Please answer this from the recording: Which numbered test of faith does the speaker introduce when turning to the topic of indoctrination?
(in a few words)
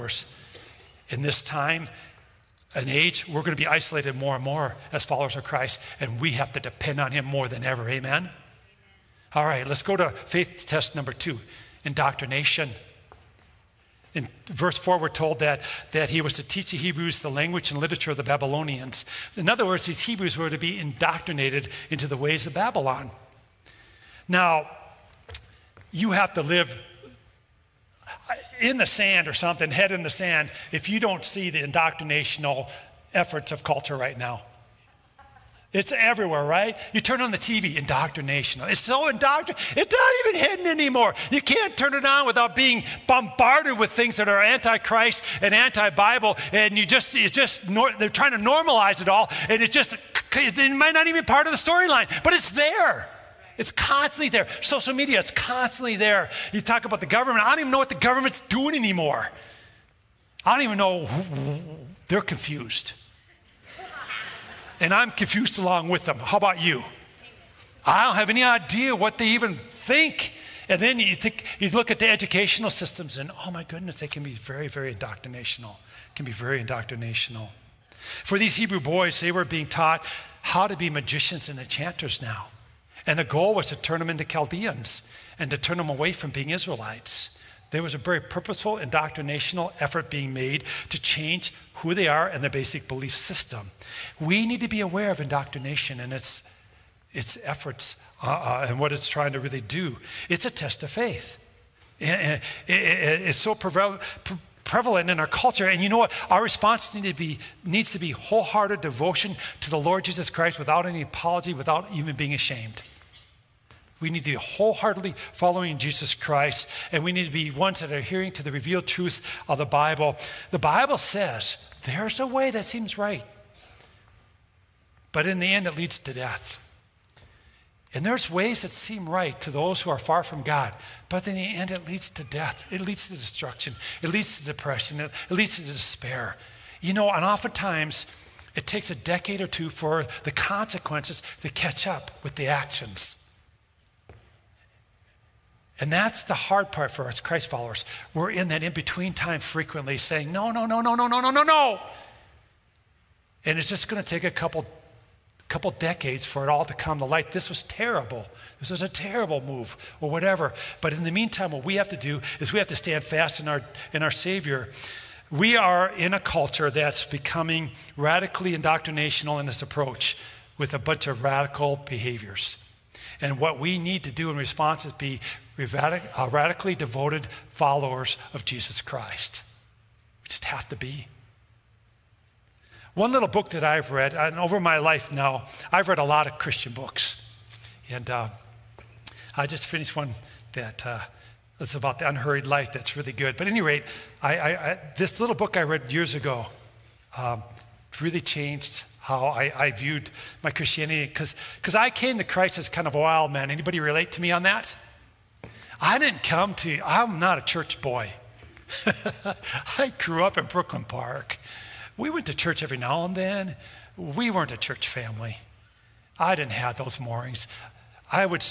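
2.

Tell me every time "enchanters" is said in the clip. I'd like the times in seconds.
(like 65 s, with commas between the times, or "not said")
81 s.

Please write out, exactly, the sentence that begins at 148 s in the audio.
We're in that in between time frequently saying, no, no, no, no, no, no, no, no, no.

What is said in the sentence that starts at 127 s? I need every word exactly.
And there's ways that seem right to those who are far from God, but in the end, it leads to death.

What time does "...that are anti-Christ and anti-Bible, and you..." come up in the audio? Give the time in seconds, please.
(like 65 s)
44 s.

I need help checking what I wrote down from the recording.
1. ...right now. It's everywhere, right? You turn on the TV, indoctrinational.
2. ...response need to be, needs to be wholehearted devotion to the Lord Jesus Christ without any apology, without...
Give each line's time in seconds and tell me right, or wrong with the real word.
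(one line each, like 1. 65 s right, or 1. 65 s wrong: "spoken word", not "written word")
1. 33 s right
2. 106 s right.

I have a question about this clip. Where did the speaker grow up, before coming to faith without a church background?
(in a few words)
Brooklyn Park.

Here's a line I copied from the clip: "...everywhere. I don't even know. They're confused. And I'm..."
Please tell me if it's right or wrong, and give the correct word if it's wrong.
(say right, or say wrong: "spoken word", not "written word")
wrong: "anymore", not "everywhere".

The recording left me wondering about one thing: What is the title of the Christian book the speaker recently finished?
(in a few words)
The unhurried life.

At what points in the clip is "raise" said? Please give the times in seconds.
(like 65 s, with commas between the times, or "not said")
not said.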